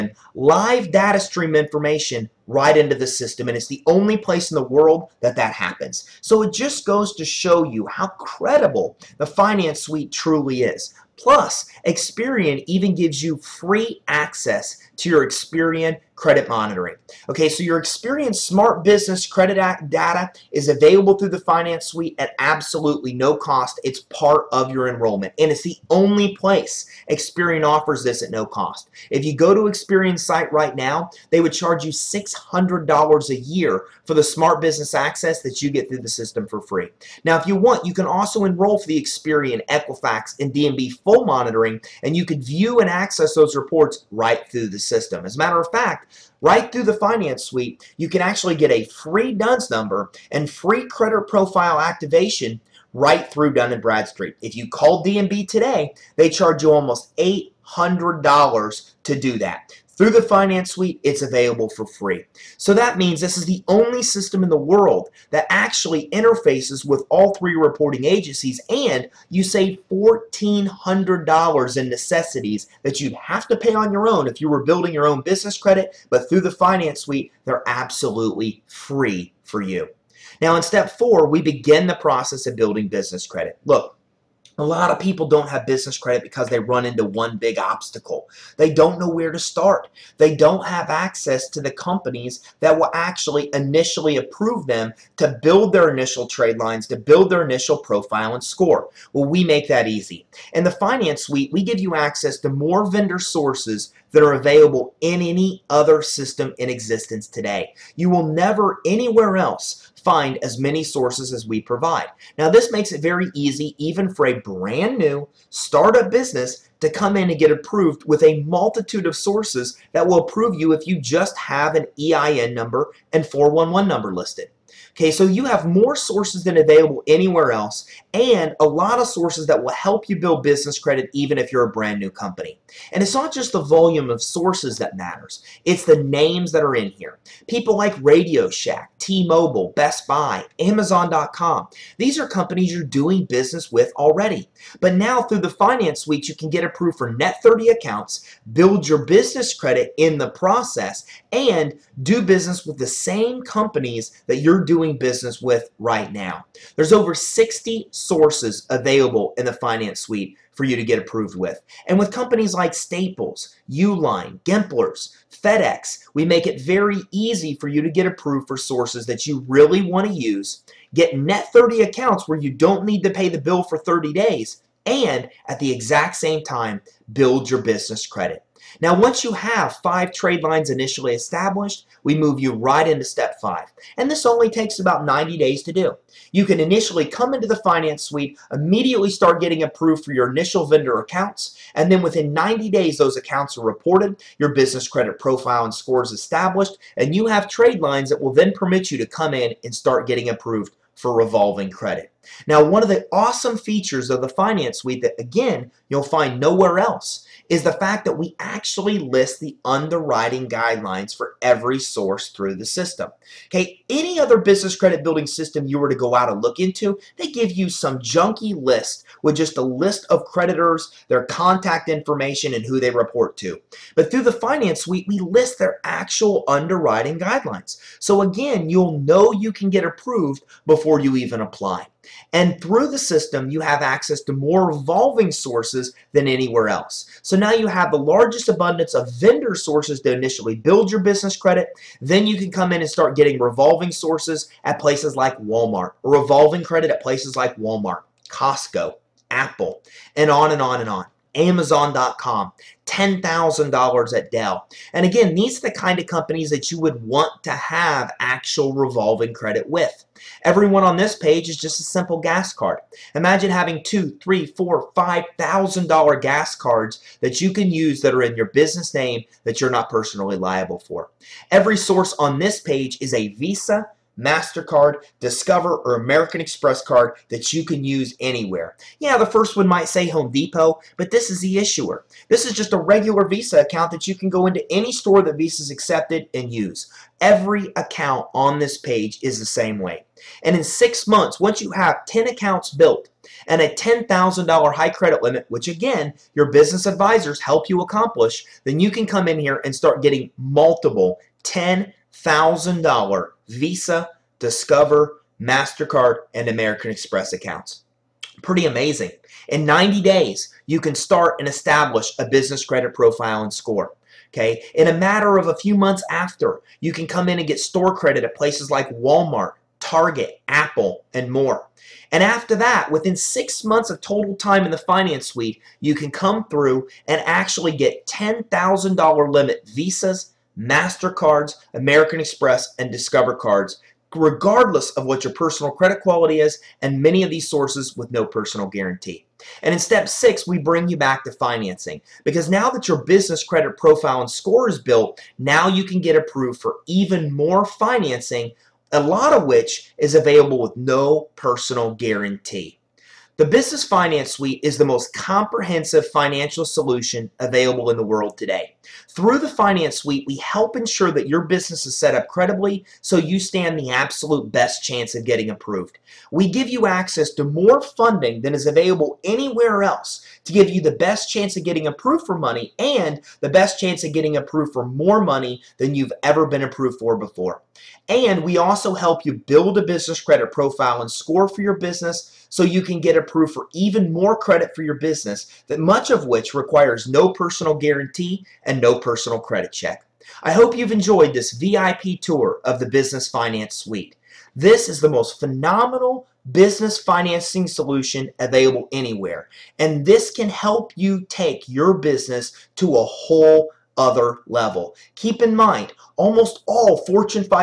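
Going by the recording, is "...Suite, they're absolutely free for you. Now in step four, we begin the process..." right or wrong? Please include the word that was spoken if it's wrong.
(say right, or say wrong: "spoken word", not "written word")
right.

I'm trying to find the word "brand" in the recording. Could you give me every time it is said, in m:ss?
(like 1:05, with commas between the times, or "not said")
1:54, 2:11.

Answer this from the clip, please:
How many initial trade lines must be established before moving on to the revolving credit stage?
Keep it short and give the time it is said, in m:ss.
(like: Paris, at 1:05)
5, at 2:59.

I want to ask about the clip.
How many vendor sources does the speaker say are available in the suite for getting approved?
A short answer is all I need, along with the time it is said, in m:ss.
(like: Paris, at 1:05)
over 60, at 2:36.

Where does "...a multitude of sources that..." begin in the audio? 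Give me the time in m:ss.
1:58.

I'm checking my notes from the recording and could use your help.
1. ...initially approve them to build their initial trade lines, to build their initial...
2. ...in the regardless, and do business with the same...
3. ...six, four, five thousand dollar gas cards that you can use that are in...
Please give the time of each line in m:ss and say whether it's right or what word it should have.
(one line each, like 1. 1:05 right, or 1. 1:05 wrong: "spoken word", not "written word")
1. 1:33 right
2. 2:29 wrong: "process", not "regardless"
3. 4:24 wrong: "three", not "six".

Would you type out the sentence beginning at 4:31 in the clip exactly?
Every source on this page is a Visa, MasterCard, Discover, or American Express card that you can use anywhere.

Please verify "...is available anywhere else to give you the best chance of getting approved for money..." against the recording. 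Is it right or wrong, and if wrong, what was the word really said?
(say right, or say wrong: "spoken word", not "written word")
right.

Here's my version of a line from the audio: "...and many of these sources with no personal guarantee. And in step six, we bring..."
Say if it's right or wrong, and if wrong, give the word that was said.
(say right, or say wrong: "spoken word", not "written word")
right.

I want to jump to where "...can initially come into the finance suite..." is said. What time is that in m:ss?
3:06.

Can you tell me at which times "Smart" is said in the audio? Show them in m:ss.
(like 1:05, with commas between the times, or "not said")
0:18, 0:34.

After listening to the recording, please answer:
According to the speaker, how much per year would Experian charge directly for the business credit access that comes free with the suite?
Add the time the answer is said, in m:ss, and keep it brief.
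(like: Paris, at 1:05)
$600, at 0:31.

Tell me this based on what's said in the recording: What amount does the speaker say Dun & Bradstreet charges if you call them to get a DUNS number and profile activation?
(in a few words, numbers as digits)
almost $800.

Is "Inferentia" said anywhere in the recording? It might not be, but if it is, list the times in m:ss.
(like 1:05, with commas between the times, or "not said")
not said.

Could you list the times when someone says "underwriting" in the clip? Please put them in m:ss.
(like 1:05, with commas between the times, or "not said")
3:29, 3:46.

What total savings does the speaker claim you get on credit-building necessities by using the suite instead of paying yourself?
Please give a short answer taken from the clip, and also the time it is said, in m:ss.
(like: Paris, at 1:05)
$1,400, at 1:09.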